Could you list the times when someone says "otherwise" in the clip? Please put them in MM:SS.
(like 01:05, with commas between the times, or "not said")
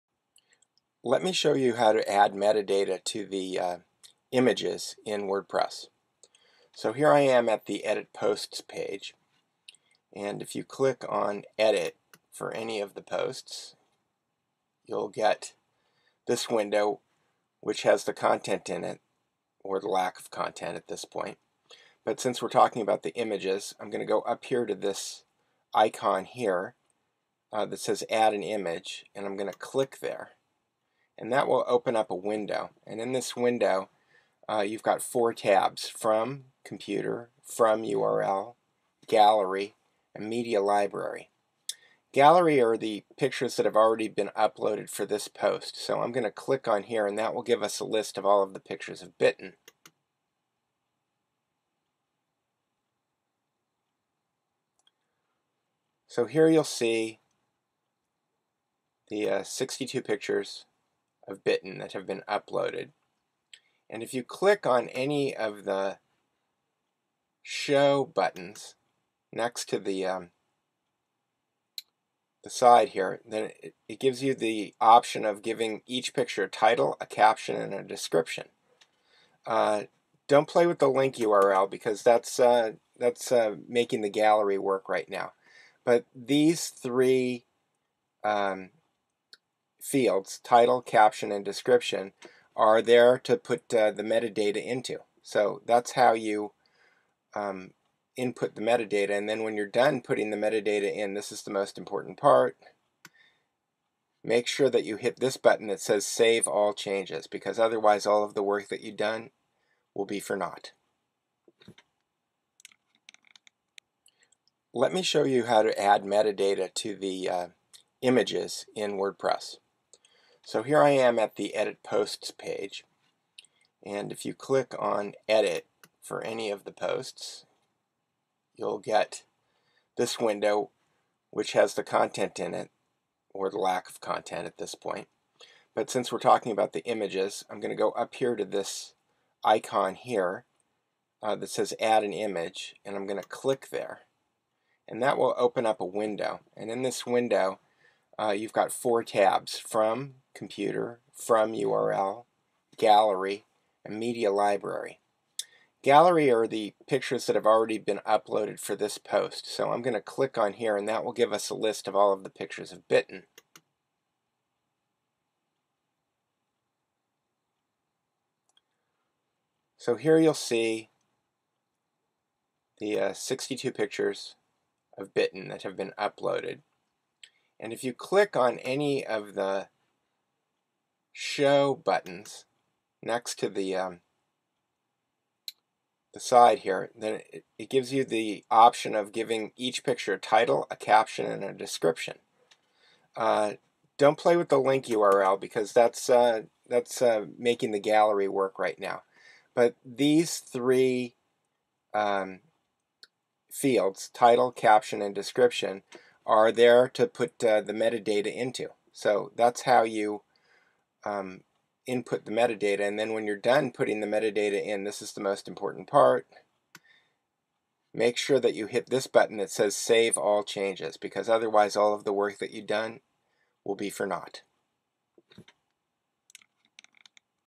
01:47, 03:41.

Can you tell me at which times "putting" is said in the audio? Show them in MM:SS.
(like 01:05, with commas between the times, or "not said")
01:40, 03:33.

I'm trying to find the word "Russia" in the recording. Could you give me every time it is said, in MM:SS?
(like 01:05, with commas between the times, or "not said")
not said.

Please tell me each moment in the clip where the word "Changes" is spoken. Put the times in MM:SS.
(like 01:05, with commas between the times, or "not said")
01:46, 03:40.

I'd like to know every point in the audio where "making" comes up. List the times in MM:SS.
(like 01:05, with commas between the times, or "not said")
01:23, 03:17.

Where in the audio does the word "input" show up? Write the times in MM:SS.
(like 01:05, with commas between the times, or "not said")
01:38, 03:31.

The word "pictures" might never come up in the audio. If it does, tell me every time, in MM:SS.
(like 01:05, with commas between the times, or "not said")
00:43, 00:48, 01:00, 01:16, 02:36, 02:42, 02:53, 03:09.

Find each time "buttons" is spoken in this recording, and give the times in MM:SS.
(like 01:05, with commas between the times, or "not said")
01:08, 01:45, 03:01, 03:39.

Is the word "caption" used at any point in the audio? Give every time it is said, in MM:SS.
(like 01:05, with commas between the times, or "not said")
01:17, 01:30, 03:10, 03:24.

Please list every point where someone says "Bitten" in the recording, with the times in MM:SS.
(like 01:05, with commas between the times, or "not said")
00:49, 01:01, 02:42, 02:55.